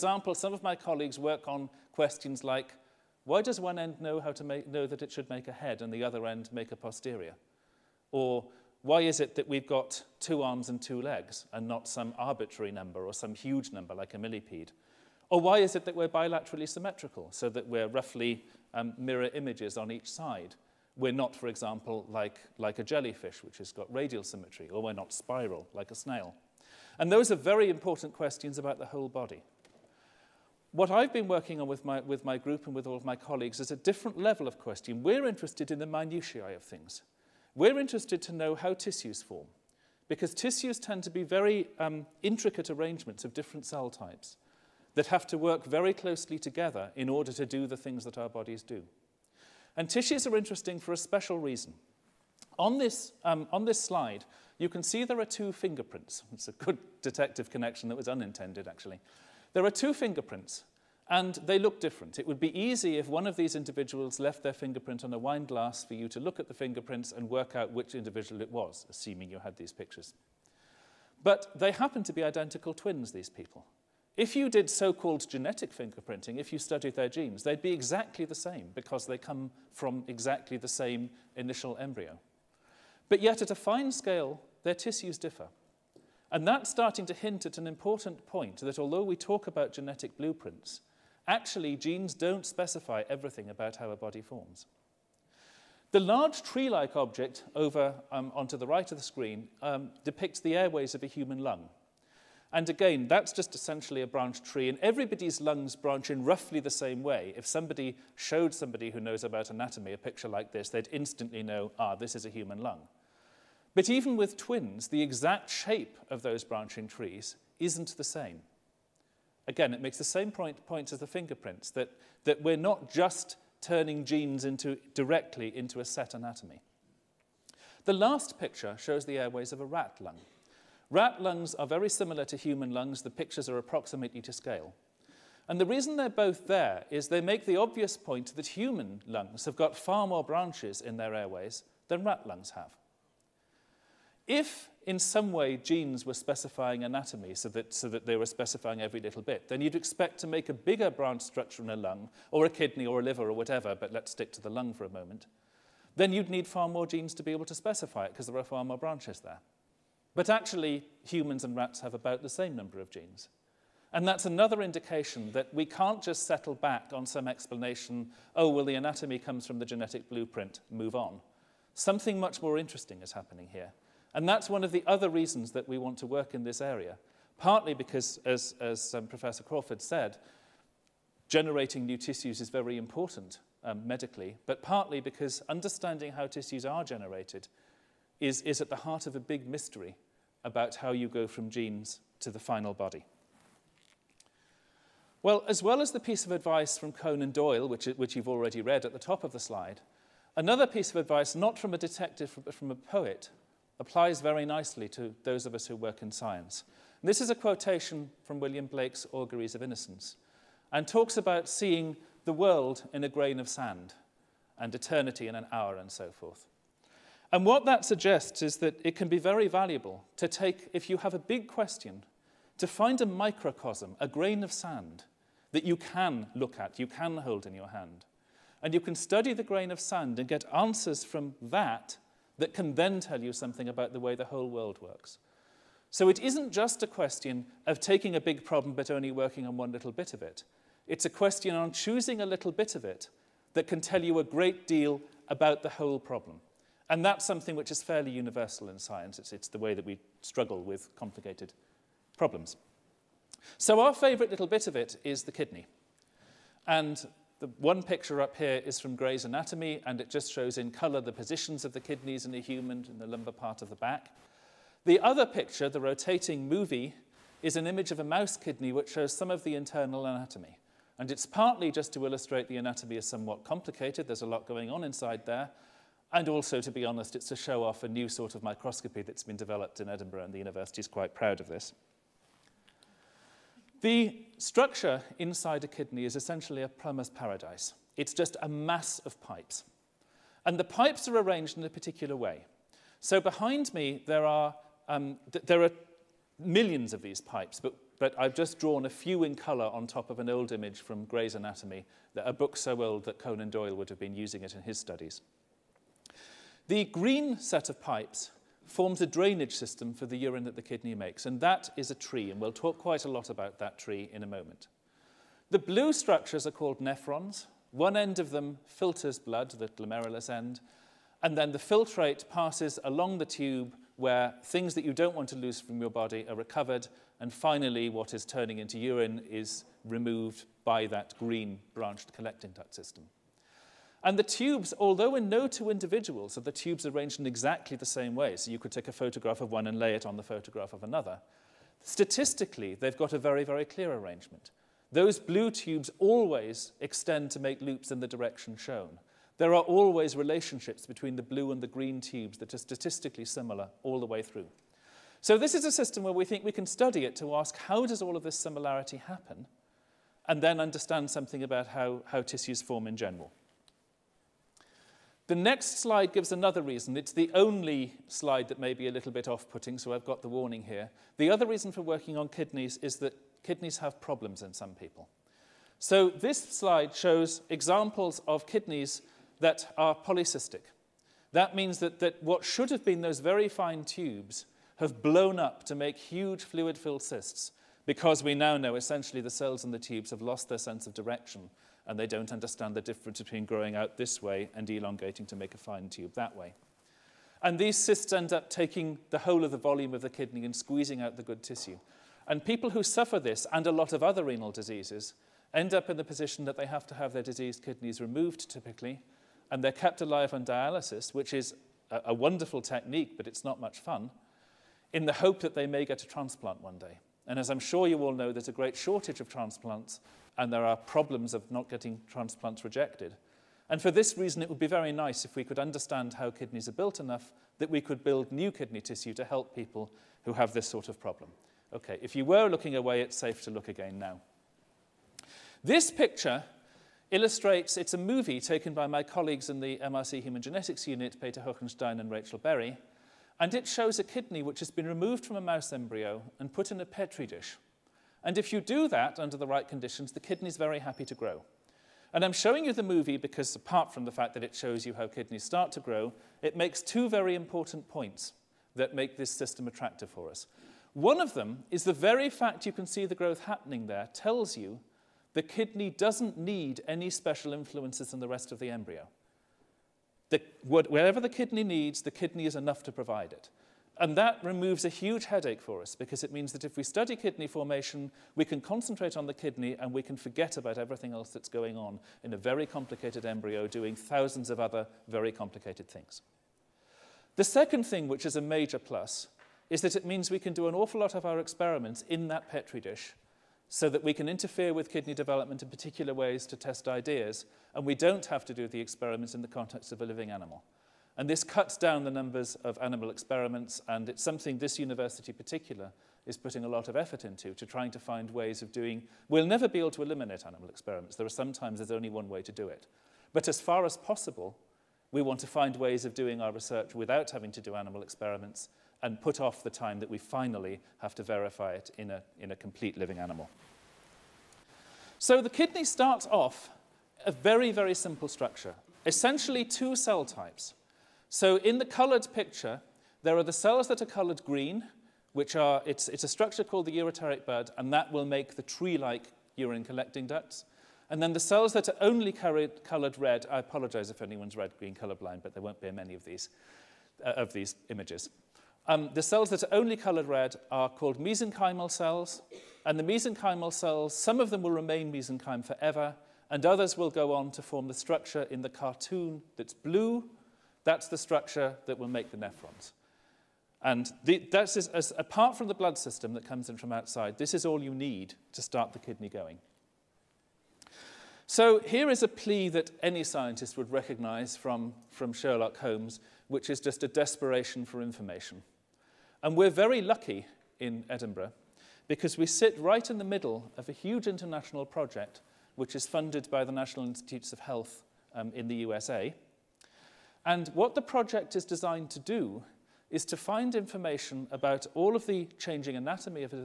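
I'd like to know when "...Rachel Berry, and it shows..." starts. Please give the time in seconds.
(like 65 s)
442 s.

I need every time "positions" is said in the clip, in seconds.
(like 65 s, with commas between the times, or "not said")
261 s, 406 s.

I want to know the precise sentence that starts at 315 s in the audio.
The blue structures are called nephrons.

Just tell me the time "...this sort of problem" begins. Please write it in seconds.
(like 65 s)
430 s.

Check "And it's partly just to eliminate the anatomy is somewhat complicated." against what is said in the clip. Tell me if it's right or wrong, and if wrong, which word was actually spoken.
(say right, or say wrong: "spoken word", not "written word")
wrong: "illustrate", not "eliminate".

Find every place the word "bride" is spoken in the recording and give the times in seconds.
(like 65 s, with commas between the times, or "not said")
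not said.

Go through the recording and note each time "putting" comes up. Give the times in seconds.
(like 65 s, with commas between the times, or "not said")
369 s, 506 s.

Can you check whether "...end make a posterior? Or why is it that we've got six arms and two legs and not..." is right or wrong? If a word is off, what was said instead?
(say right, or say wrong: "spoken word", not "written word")
wrong: "two", not "six".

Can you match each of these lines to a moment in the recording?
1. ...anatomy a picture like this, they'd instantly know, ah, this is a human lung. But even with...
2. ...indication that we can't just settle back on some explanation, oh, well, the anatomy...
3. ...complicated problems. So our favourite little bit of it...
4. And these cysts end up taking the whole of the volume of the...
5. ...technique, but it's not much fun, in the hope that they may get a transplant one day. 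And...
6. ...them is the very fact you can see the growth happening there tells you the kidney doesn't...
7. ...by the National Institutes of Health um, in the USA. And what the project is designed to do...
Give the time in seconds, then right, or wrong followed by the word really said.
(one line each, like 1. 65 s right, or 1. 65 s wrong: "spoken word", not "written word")
1. 109 s right
2. 164 s right
3. 250 s right
4. 397 s right
5. 412 s right
6. 461 s right
7. 586 s right.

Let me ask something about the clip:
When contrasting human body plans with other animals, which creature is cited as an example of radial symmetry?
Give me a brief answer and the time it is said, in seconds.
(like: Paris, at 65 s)
jellyfish, at 22 s.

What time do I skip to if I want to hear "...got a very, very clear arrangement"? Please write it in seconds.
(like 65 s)
342 s.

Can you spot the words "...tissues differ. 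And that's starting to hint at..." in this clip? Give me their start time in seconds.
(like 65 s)
84 s.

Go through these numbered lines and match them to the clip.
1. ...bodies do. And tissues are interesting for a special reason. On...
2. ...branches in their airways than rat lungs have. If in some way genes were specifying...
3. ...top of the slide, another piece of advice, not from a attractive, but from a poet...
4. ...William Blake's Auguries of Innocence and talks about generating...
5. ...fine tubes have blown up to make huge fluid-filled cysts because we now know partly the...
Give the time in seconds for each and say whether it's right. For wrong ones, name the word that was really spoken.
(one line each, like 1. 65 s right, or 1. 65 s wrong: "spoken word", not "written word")
1. 48 s right
2. 140 s right
3. 198 s wrong: "detective", not "attractive"
4. 208 s wrong: "seeing", not "generating"
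5. 383 s wrong: "essentially", not "partly".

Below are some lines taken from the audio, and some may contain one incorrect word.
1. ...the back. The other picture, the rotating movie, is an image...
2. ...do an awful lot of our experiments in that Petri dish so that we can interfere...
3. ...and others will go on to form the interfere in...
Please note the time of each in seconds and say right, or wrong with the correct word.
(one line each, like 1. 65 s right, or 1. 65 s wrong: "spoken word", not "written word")
1. 263 s right
2. 490 s right
3. 556 s wrong: "structure", not "interfere".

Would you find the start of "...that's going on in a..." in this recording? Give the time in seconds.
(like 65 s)
481 s.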